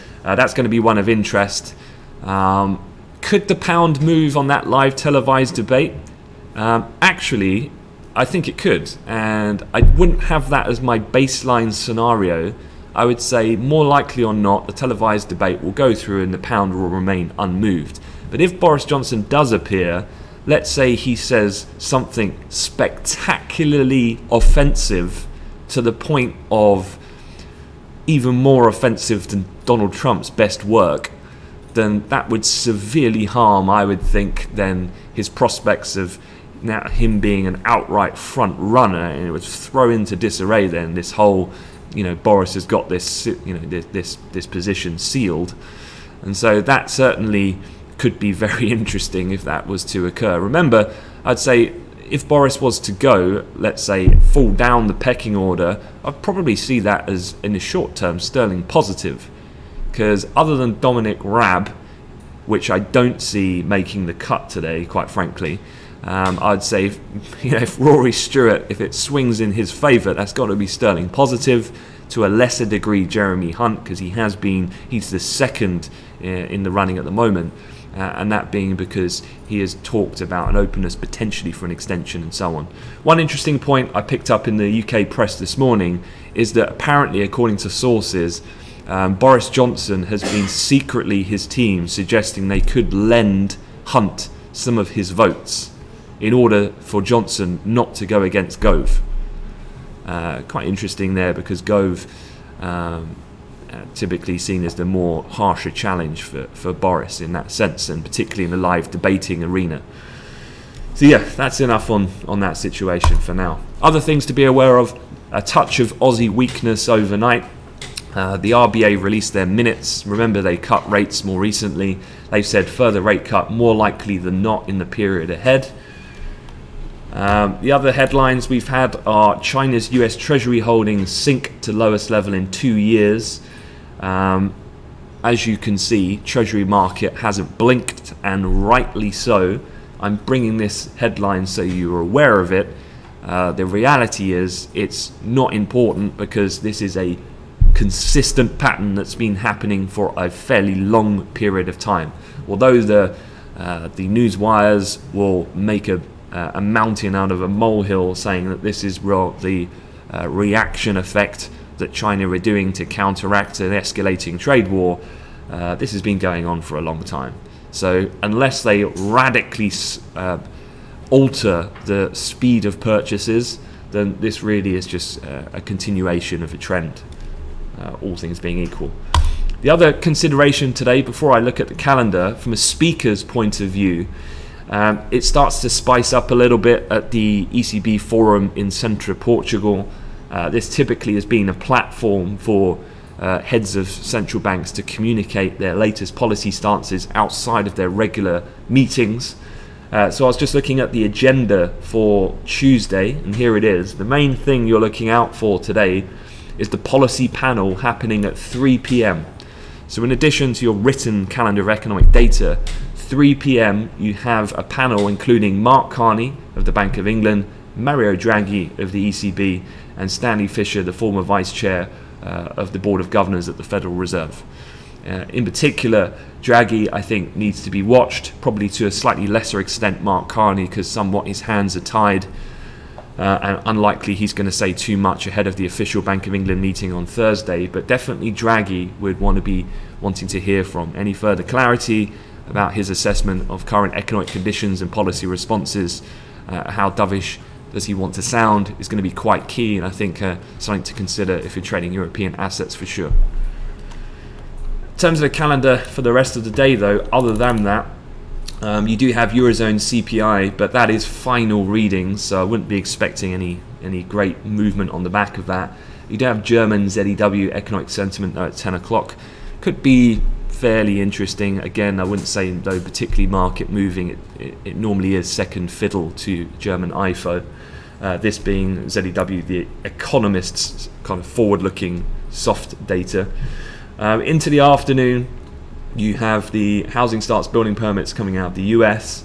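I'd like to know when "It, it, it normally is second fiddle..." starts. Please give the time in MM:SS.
04:34.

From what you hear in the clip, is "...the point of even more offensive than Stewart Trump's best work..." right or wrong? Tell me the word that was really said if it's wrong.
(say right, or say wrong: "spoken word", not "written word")
wrong: "Donald", not "Stewart".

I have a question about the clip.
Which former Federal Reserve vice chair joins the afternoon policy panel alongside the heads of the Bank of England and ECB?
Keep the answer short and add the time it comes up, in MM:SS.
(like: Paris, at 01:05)
Stanley Fischer, at 03:40.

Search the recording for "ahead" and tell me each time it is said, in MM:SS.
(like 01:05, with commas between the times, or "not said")
02:05, 03:55.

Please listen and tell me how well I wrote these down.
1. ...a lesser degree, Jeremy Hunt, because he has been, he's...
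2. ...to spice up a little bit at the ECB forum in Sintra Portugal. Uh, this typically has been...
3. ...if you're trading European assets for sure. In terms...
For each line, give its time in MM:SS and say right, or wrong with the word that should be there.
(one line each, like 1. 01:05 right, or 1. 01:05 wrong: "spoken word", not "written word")
1. 01:12 right
2. 03:05 right
3. 04:11 right.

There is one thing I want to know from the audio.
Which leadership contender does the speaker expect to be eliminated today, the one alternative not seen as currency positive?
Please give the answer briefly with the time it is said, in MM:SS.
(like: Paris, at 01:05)
Dominic Raab, at 01:00.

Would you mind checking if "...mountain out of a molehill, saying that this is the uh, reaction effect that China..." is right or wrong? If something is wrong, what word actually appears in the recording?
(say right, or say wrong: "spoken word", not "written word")
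right.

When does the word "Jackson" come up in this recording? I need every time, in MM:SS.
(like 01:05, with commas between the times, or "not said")
not said.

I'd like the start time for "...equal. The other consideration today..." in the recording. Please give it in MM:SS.
02:58.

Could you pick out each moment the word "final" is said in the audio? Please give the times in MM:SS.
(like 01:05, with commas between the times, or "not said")
04:21.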